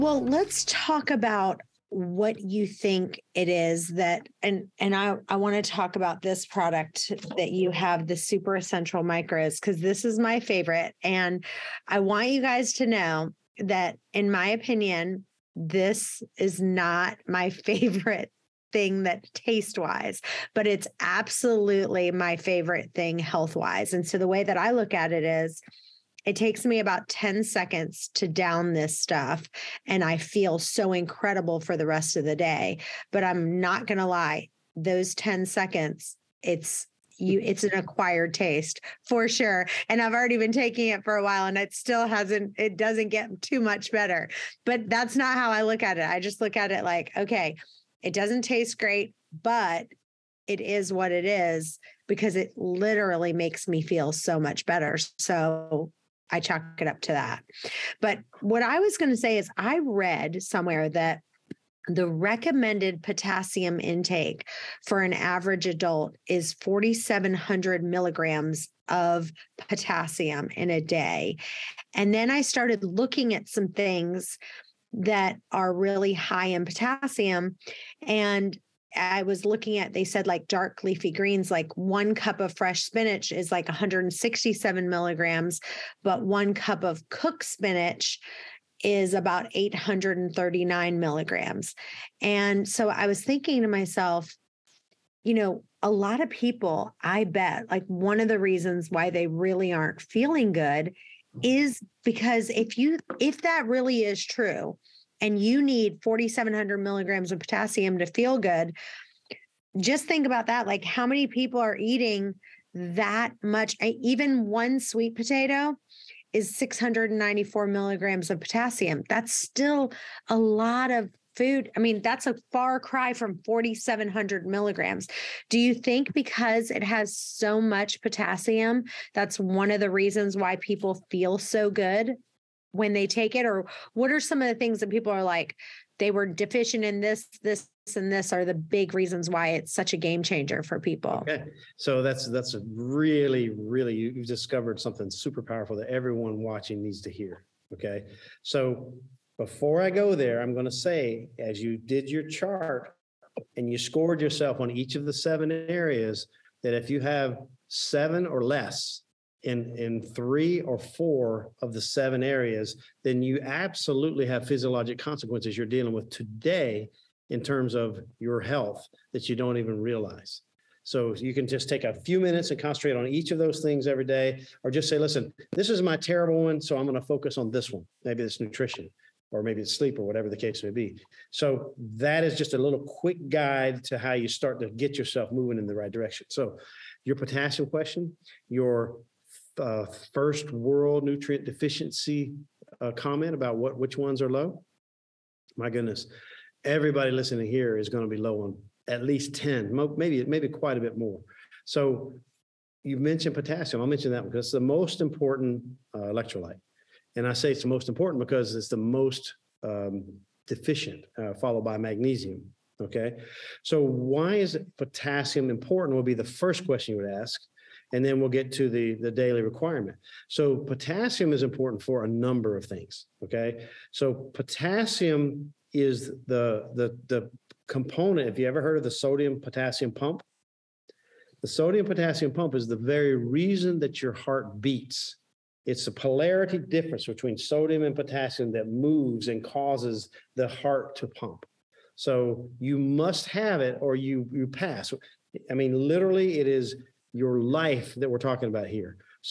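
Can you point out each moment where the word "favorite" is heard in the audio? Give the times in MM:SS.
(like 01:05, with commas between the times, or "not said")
00:10, 00:17, 00:22.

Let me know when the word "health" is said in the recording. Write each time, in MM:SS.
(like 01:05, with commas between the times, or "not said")
00:23, 02:48.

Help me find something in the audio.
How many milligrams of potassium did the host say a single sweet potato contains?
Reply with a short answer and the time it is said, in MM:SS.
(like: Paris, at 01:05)
694 milligrams, at 01:56.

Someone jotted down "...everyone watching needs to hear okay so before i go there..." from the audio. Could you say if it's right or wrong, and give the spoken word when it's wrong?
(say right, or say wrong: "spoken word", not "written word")
right.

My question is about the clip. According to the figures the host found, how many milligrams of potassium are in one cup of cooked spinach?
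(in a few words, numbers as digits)
839 milligrams.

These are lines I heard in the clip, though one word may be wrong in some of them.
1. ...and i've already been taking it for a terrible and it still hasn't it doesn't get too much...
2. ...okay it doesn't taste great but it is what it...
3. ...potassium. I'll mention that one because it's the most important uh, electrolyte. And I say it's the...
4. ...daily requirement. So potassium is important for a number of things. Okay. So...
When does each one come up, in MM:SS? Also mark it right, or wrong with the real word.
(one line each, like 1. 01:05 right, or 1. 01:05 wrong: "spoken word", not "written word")
1. 00:39 wrong: "while", not "terrible"
2. 00:47 right
3. 03:23 right
4. 03:39 right.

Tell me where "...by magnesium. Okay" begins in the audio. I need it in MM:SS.
03:31.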